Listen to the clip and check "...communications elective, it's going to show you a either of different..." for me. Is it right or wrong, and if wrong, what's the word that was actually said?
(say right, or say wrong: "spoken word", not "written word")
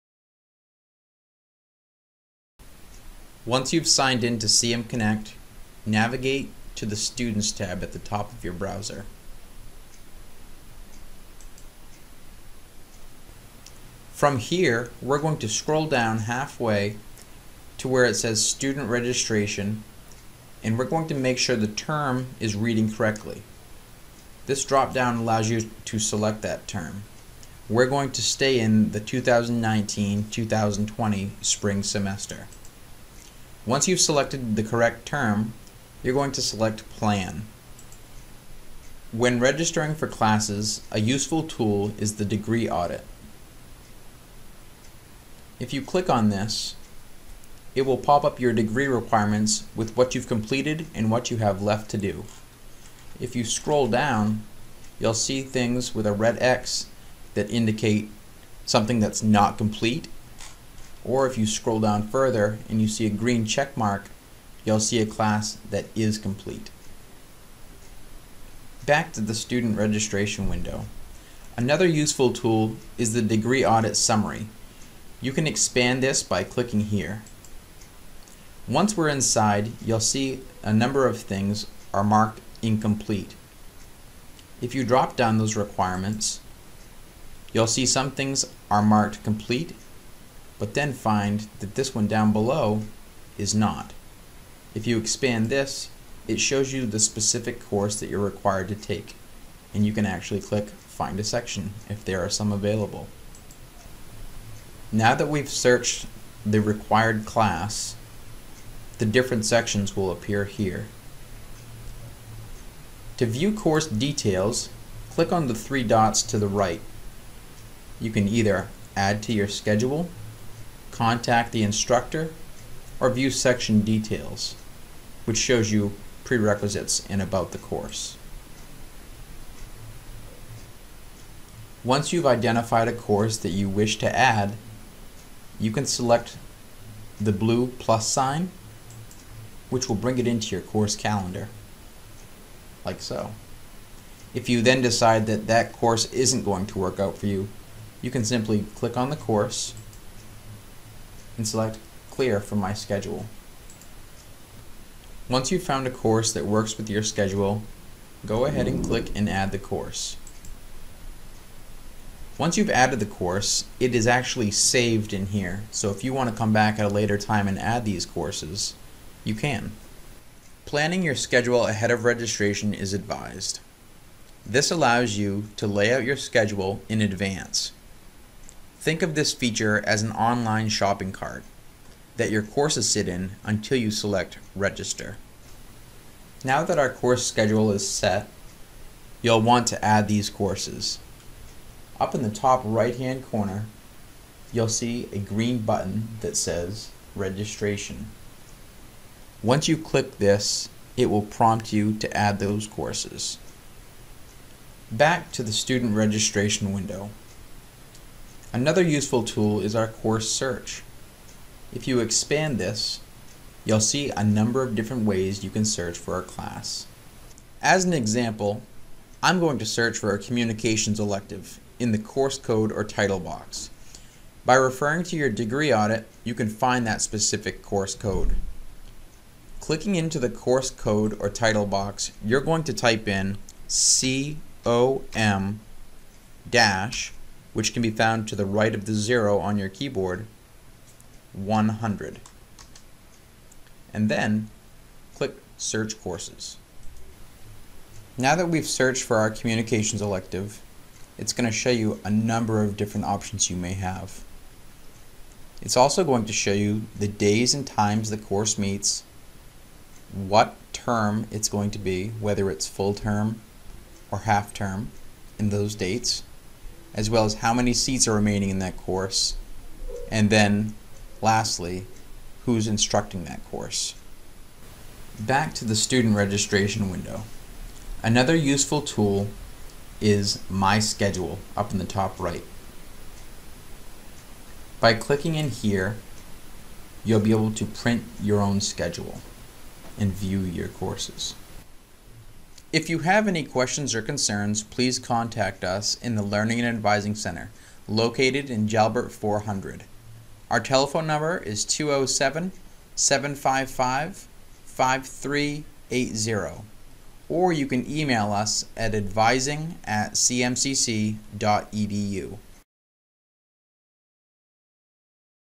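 wrong: "number", not "either".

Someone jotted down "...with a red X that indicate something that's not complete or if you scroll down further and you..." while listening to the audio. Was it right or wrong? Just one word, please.
right.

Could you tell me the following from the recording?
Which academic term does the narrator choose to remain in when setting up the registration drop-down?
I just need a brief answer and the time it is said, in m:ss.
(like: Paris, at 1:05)
2019-2020 spring semester, at 0:29.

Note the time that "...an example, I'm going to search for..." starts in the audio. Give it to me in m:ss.
3:37.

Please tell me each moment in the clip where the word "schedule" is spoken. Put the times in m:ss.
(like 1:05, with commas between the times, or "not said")
1:59, 2:32, 2:37, 2:51, 2:56, 3:07, 4:40, 4:48.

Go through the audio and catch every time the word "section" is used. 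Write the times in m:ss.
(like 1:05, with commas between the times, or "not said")
1:41, 1:49, 2:03.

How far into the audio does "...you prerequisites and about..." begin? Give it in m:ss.
2:05.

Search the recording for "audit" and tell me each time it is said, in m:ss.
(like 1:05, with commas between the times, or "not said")
0:42, 1:13, 3:45.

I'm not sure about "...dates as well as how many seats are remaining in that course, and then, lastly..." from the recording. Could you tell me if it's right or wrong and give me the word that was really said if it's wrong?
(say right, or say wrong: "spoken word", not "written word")
right.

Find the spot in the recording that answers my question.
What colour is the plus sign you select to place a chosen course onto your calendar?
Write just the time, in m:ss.
2:17.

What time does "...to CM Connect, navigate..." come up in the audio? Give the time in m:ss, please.
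0:04.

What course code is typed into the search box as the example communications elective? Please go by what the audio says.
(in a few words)
COM-100.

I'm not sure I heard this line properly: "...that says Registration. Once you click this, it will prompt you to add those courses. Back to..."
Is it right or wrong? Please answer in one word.
right.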